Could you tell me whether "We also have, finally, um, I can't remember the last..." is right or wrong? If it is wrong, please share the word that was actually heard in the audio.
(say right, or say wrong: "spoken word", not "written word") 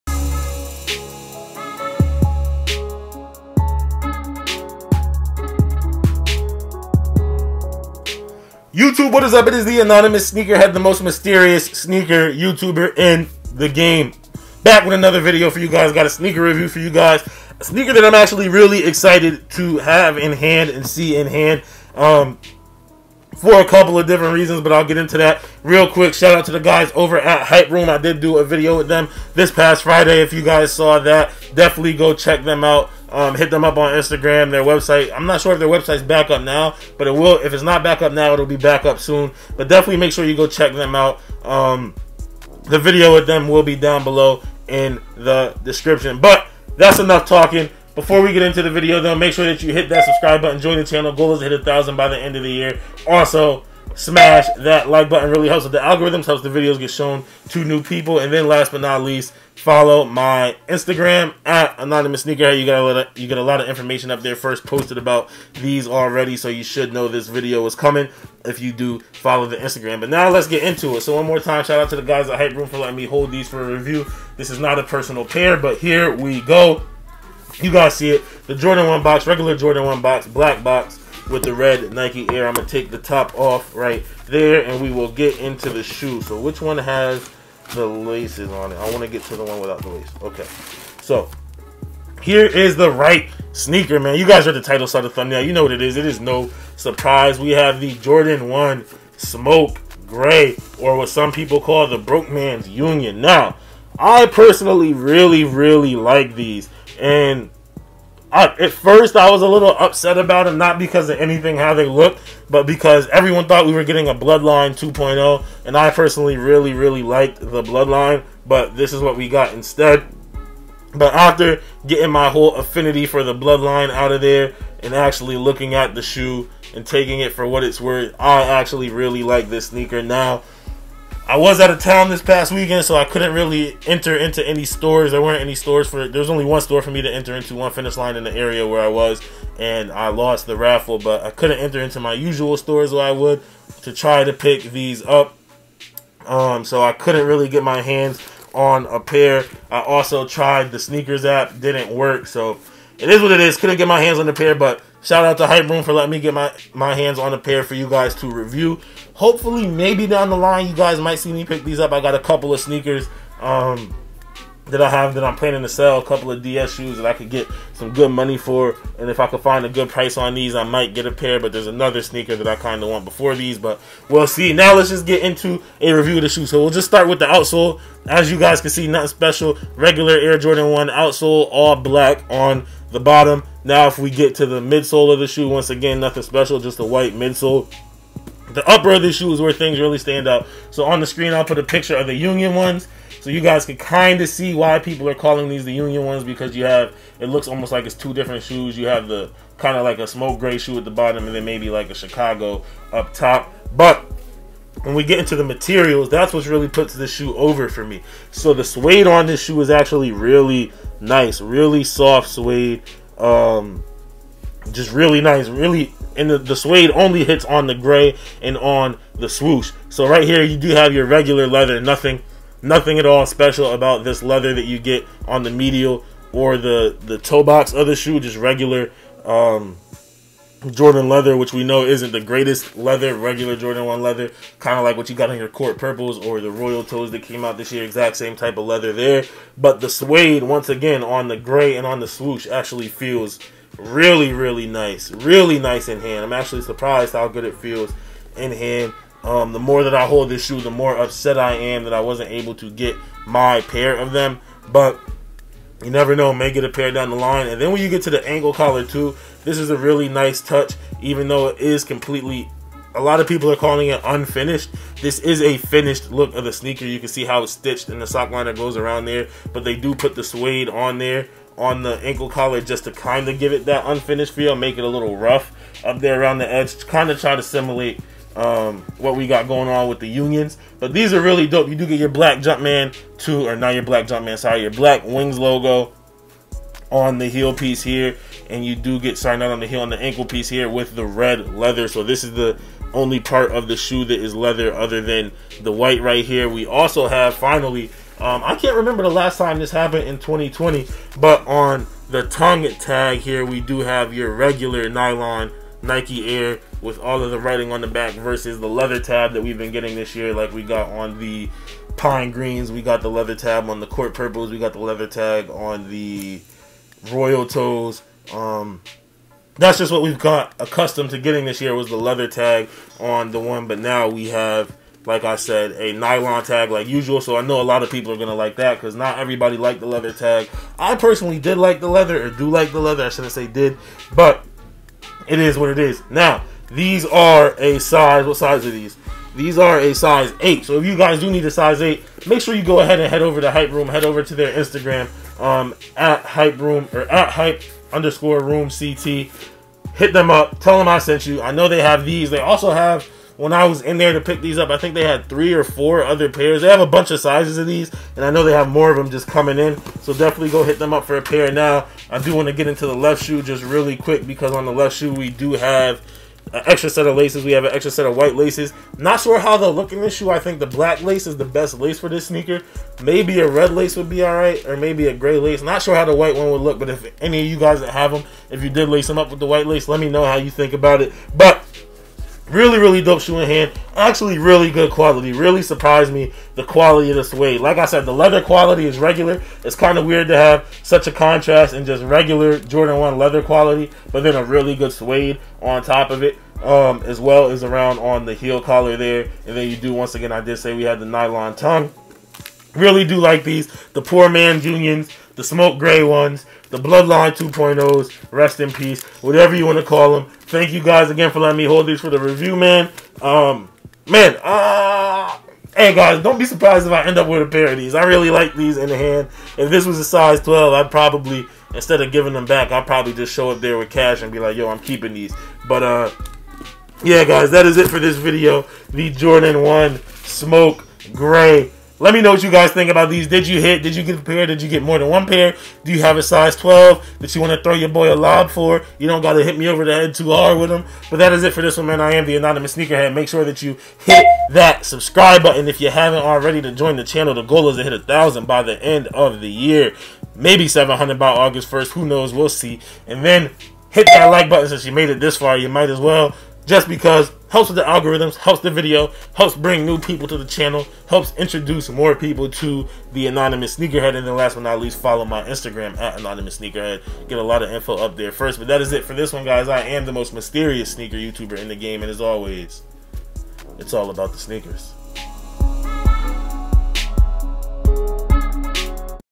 right.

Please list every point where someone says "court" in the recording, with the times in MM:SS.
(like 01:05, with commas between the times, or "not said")
03:55, 05:13.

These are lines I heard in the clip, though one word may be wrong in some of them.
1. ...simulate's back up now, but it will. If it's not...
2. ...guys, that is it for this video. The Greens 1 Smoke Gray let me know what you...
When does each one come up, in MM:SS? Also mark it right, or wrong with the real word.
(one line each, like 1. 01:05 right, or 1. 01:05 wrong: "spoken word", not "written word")
1. 00:35 wrong: "website", not "simulate"
2. 07:07 wrong: "Jordan", not "Greens".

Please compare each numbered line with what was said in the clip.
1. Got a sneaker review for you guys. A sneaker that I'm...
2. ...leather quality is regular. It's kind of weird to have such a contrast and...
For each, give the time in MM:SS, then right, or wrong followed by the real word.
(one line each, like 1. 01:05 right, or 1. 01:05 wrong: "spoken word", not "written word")
1. 00:15 right
2. 06:28 right.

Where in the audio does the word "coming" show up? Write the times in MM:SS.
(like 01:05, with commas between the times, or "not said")
01:07, 05:59.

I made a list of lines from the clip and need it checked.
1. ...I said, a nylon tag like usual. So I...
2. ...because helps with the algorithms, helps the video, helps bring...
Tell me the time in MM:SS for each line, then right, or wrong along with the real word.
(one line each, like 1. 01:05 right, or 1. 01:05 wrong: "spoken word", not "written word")
1. 05:25 right
2. 07:36 right.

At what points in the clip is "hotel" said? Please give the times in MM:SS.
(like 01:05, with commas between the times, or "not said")
not said.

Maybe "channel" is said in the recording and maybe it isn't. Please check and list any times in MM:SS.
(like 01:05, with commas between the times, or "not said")
00:50, 07:27, 07:40.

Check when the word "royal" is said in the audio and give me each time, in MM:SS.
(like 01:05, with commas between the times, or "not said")
03:56, 05:17.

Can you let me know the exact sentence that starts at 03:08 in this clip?
The upper of the shoe is where things really stand out.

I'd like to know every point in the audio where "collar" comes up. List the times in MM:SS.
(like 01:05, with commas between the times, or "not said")
04:18, 04:32, 06:38.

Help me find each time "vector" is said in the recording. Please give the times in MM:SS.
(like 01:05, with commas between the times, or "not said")
not said.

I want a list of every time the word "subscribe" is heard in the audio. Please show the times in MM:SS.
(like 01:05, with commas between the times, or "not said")
00:50, 07:24.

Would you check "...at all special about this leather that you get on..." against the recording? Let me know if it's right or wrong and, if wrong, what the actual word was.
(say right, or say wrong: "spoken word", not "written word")
right.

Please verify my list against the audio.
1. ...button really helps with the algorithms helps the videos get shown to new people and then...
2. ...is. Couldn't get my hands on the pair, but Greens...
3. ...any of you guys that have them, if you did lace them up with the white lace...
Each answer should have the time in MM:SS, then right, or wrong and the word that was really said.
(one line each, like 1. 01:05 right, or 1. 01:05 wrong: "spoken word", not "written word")
1. 00:55 right
2. 02:33 wrong: "Shout", not "Greens"
3. 06:17 right.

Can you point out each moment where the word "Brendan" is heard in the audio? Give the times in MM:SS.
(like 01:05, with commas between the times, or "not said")
not said.